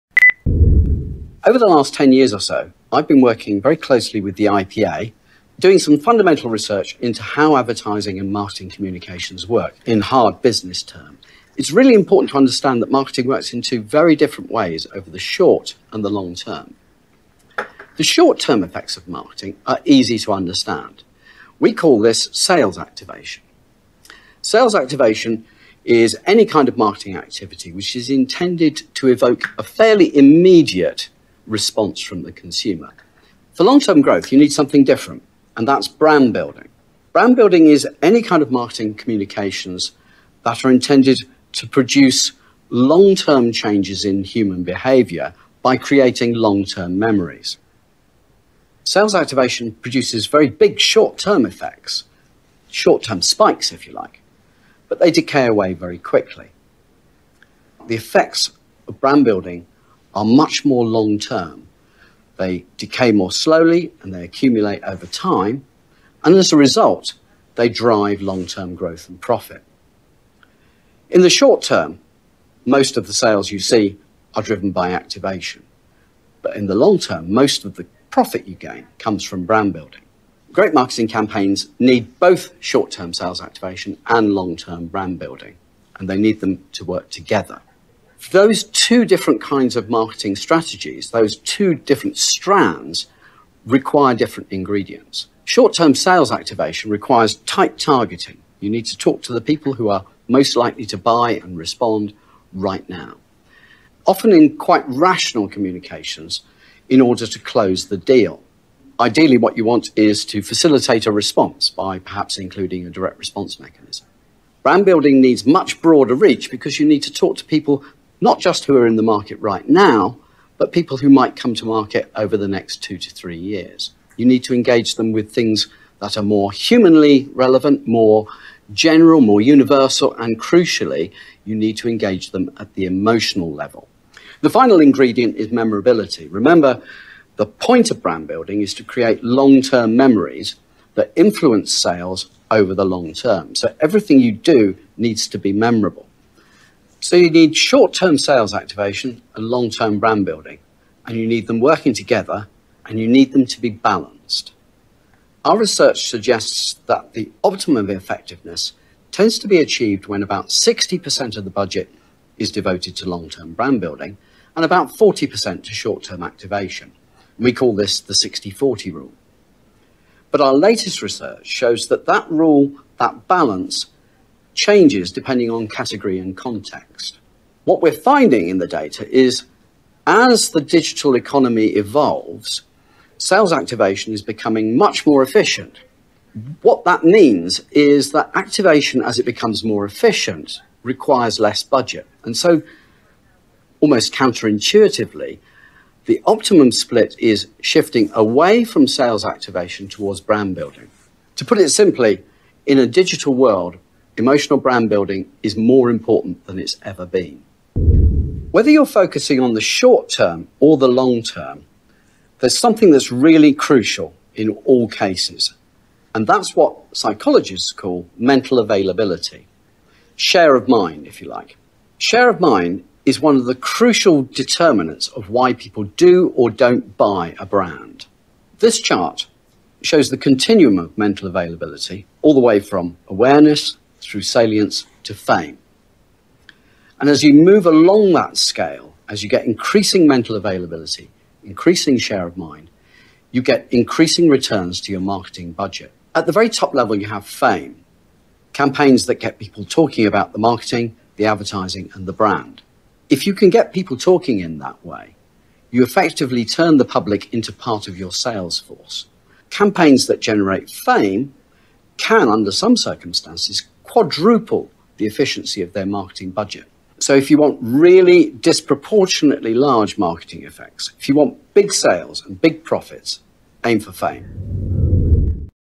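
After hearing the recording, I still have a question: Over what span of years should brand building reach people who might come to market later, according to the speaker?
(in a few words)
2 to 3 years.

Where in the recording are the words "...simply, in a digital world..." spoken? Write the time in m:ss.
3:21.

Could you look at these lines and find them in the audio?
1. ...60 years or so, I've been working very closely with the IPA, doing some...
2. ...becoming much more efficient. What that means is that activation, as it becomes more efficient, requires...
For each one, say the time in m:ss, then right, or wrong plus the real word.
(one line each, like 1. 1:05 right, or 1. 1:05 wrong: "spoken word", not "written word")
1. 0:01 wrong: "10", not "60"
2. 3:04 right.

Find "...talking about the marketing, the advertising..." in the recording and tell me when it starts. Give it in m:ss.
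4:09.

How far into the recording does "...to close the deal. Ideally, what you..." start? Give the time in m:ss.
1:47.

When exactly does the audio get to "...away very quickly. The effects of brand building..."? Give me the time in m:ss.
0:55.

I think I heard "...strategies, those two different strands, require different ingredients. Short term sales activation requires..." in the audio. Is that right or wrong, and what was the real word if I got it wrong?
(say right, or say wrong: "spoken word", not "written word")
right.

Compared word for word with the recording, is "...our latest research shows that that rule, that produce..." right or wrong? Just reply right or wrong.
wrong.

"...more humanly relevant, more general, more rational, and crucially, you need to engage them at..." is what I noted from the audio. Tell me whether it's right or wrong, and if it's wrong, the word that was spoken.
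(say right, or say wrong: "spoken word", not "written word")
wrong: "universal", not "rational".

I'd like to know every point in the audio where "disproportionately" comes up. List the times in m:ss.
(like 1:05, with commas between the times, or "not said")
4:28.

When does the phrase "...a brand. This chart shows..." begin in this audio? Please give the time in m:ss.
3:47.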